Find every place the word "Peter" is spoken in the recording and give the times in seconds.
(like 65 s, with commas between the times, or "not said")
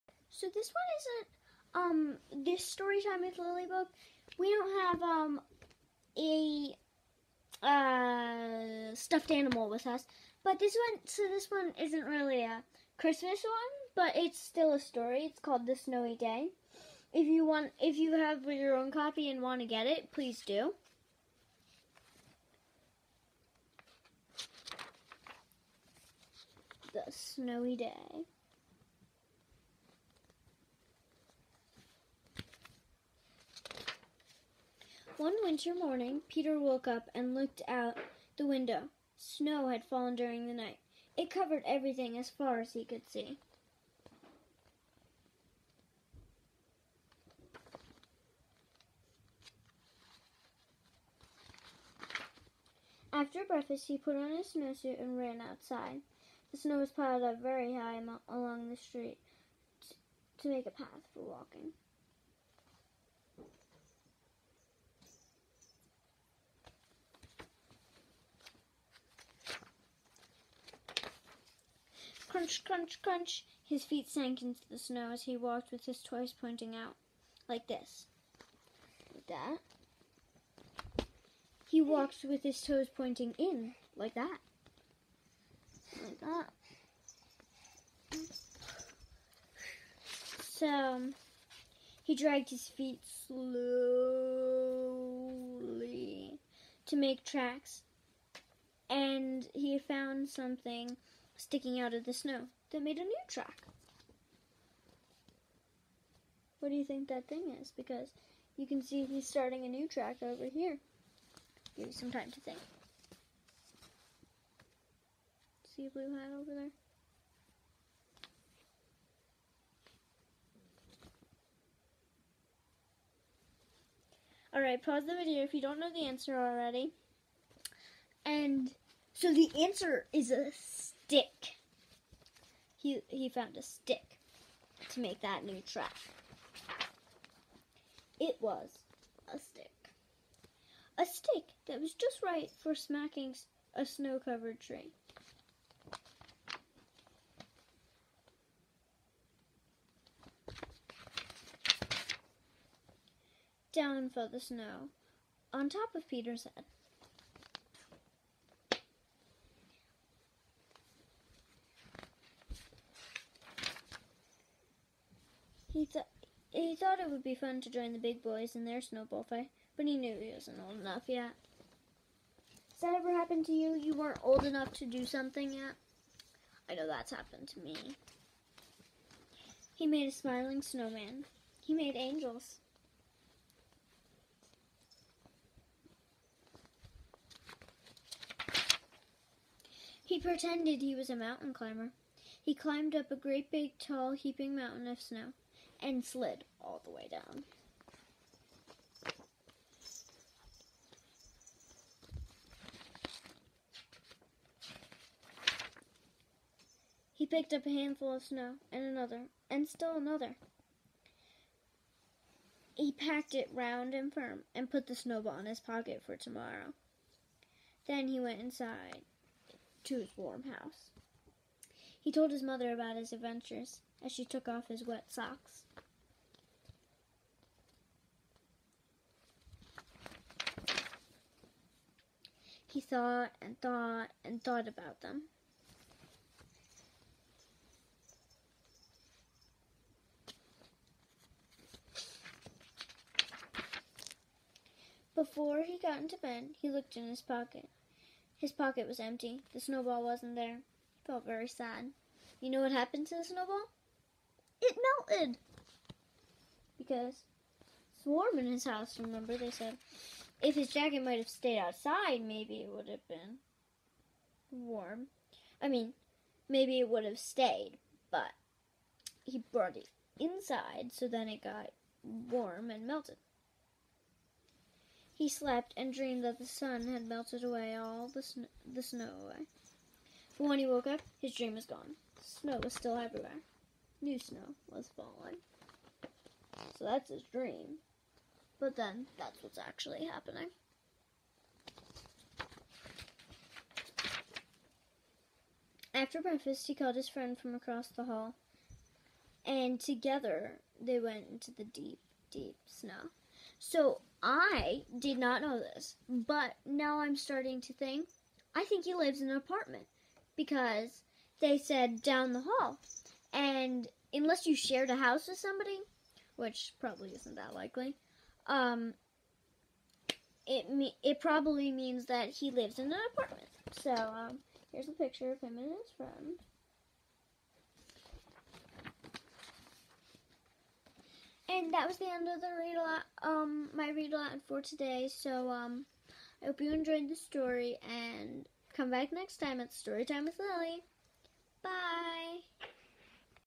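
36 s, 156 s.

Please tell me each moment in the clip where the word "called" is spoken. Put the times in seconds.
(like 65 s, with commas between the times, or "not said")
15 s, 296 s.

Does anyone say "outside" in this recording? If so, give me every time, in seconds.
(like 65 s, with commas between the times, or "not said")
55 s, 261 s.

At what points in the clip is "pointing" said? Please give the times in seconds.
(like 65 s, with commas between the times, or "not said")
76 s, 82 s.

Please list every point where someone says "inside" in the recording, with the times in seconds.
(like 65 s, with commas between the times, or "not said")
218 s, 270 s.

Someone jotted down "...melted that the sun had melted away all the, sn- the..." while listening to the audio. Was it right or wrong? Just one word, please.
wrong.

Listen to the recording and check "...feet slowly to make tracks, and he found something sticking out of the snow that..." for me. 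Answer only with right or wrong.
right.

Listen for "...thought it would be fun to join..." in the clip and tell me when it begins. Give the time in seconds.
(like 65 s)
166 s.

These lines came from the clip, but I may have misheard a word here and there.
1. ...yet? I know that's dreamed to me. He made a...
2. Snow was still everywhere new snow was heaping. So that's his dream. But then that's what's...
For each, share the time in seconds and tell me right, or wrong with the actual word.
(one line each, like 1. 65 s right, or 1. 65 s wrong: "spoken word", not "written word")
1. 175 s wrong: "happened", not "dreamed"
2. 282 s wrong: "falling", not "heaping".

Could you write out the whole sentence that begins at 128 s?
And so the answer is a stick.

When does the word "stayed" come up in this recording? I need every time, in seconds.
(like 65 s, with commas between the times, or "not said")
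261 s, 267 s.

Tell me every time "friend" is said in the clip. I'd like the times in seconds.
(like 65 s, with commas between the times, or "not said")
297 s, 325 s.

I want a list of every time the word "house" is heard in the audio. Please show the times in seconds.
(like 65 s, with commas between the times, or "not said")
220 s, 258 s, 314 s.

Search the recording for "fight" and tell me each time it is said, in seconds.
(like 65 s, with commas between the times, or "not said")
169 s.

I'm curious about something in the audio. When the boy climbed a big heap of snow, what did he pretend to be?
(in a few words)
a mountain climber.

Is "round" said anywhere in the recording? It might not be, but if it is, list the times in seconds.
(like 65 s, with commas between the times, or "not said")
213 s.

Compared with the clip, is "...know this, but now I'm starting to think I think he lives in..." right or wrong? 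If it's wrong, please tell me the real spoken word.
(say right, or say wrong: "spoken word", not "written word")
right.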